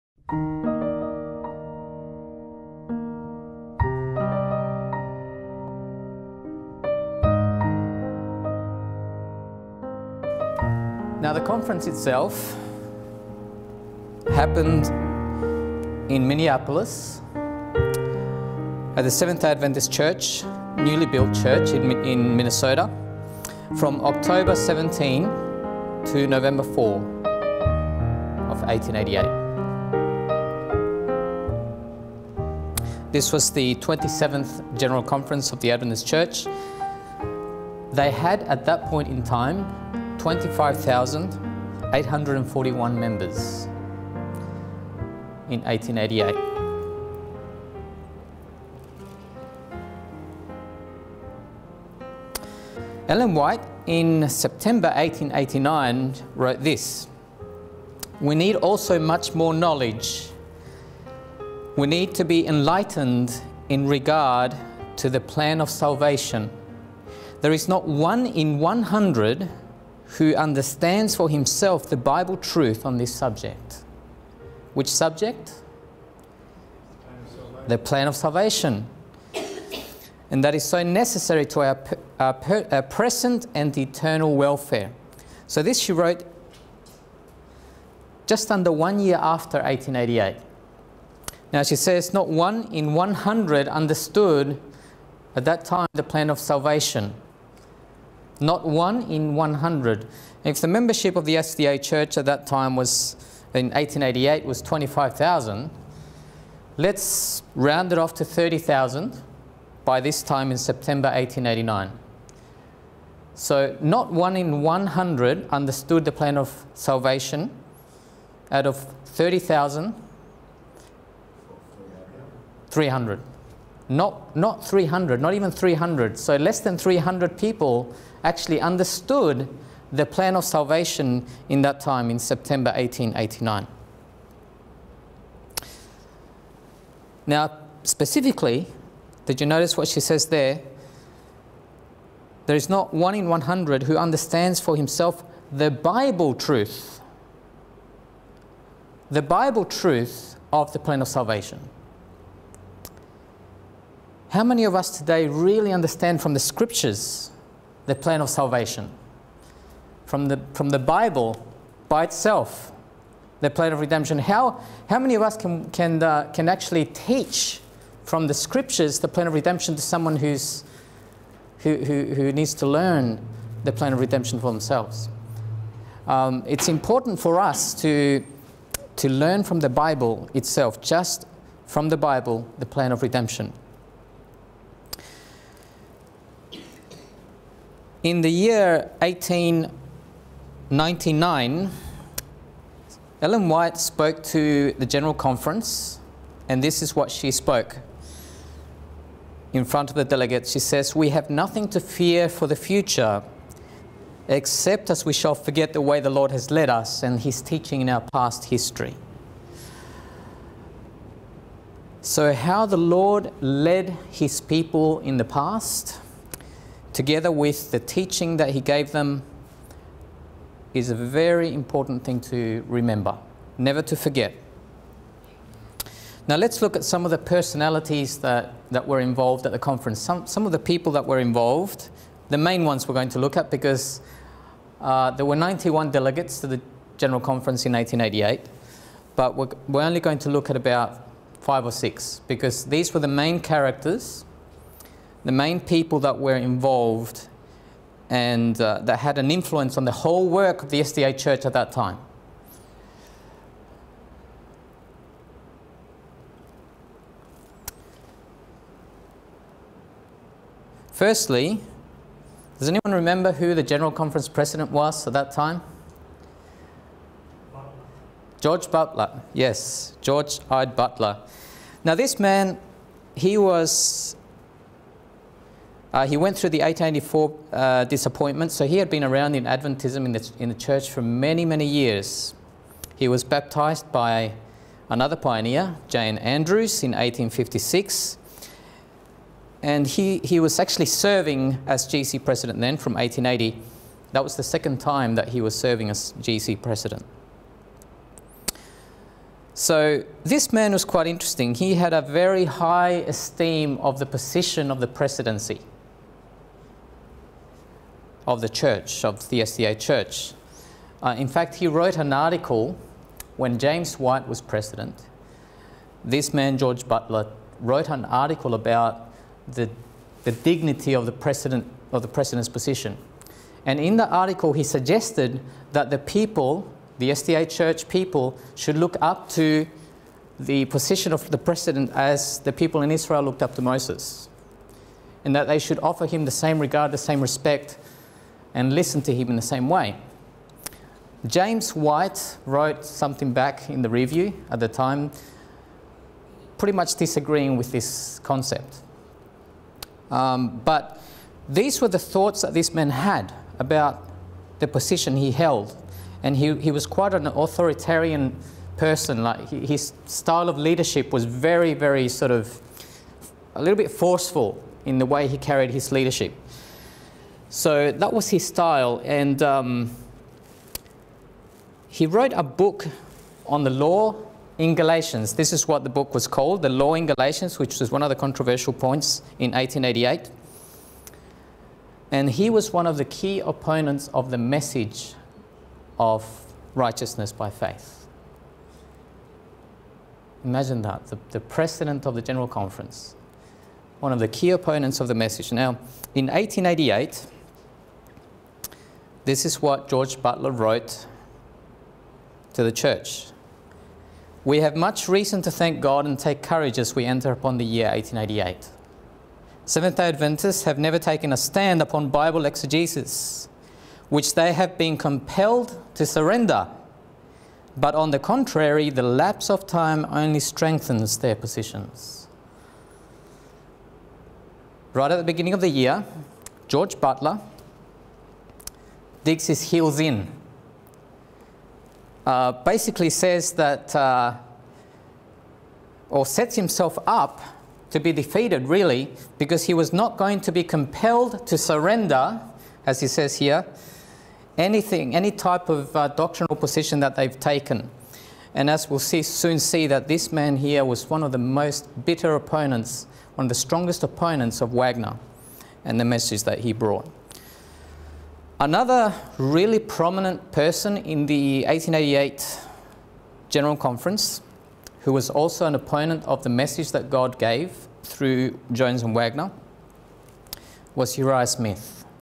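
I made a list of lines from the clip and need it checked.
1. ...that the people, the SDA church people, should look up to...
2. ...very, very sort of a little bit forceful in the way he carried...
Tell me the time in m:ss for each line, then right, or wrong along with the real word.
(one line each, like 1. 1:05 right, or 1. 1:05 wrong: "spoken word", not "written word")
1. 5:25 right
2. 6:01 right.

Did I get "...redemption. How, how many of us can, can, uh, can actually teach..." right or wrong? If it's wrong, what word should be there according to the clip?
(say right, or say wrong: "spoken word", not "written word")
right.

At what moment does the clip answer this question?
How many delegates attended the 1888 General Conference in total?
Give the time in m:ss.
3:55.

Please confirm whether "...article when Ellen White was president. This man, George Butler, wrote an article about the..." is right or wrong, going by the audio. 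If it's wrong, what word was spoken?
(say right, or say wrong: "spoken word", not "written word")
wrong: "James", not "Ellen".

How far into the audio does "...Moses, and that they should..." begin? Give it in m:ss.
5:33.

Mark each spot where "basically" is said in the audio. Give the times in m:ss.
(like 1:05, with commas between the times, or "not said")
7:12.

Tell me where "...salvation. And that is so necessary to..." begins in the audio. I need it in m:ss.
1:18.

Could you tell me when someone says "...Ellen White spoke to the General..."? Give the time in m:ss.
3:13.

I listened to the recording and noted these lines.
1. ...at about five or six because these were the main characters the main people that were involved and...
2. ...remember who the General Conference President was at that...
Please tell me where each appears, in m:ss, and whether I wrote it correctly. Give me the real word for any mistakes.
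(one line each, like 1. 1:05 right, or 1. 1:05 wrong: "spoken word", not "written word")
1. 4:00 right
2. 4:22 right.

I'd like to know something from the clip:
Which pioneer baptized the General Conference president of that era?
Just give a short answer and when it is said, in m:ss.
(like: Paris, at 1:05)
J. N. Andrews, at 4:45.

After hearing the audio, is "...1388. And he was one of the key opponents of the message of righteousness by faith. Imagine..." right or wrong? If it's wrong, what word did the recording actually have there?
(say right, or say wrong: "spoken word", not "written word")
wrong: "1888", not "1388".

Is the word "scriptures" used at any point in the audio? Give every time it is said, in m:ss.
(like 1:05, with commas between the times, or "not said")
2:36, 2:48.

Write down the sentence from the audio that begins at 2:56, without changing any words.
Um, it's important for us to, to learn from the Bible itself, just from the Bible, the plan of redemption.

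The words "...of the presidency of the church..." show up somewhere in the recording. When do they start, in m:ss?
5:04.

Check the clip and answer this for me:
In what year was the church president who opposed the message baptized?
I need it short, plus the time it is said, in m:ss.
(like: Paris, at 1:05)
1856, at 4:46.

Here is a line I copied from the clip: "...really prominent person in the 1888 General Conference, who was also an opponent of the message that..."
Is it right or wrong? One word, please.
right.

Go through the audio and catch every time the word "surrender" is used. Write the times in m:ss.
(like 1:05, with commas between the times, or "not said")
6:56, 7:21.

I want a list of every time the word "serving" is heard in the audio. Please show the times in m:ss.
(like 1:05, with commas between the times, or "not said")
4:50, 4:55.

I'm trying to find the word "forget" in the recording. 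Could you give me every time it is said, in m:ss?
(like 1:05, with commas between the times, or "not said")
3:25, 3:43.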